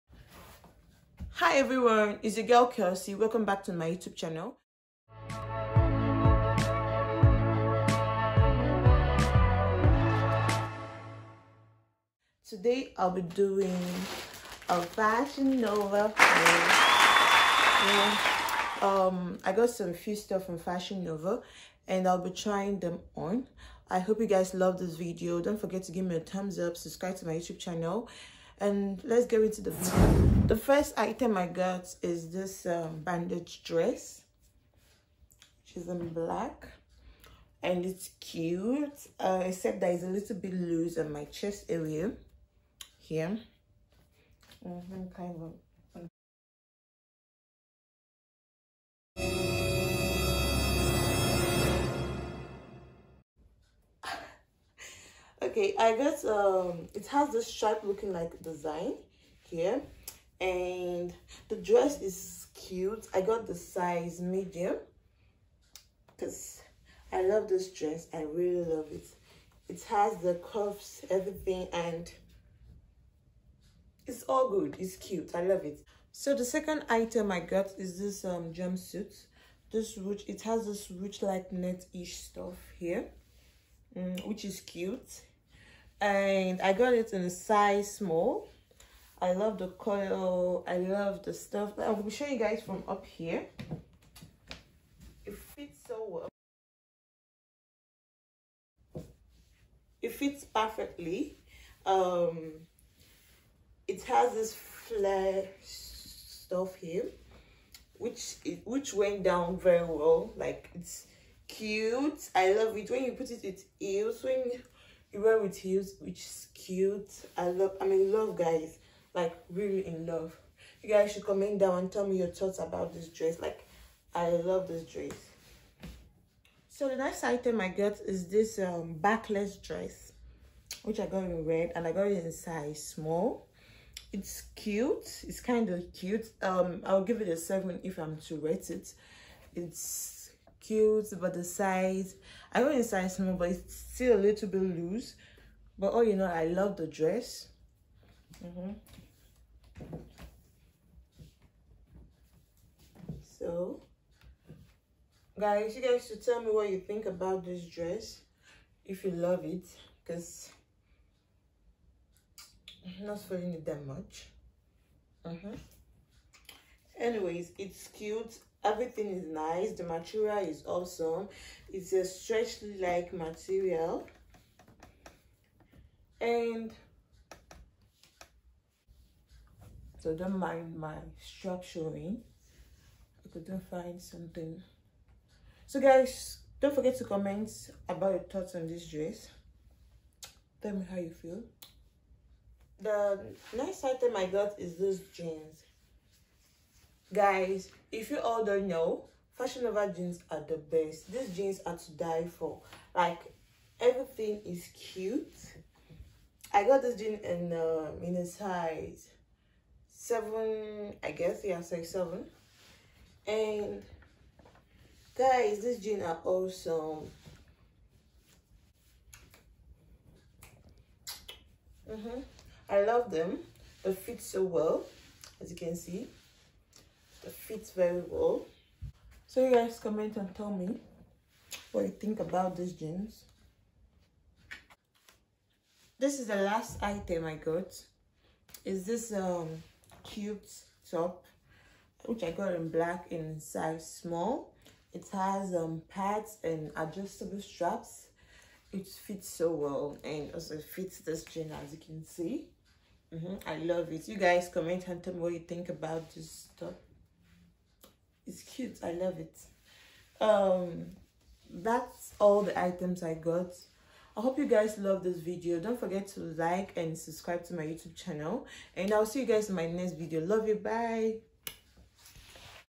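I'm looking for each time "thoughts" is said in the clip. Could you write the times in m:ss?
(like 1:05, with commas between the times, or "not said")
2:02, 3:08.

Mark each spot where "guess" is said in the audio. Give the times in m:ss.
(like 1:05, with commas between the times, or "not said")
3:31.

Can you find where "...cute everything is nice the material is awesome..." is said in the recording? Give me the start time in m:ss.
2:47.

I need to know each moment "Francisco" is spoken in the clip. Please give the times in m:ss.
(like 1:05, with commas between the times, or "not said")
not said.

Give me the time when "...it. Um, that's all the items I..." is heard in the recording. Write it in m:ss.
4:19.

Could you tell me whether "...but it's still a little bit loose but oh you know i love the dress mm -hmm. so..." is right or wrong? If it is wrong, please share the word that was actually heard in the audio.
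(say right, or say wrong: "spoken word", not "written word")
right.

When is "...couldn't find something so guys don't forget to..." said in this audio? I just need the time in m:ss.
3:03.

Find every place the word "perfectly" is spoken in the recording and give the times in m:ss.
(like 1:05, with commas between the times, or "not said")
1:40.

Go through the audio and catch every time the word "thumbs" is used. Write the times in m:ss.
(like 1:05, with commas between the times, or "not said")
0:26.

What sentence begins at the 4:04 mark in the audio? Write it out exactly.
It has um pads and adjustable straps.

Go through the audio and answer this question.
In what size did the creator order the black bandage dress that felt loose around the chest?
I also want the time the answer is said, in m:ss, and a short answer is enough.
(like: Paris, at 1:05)
Medium, at 1:03.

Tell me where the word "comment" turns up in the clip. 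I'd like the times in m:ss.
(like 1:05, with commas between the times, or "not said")
2:01, 3:07, 3:49, 4:14.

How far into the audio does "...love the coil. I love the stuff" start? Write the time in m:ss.
1:29.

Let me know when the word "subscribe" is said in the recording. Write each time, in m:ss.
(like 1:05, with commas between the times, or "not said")
0:26, 4:26.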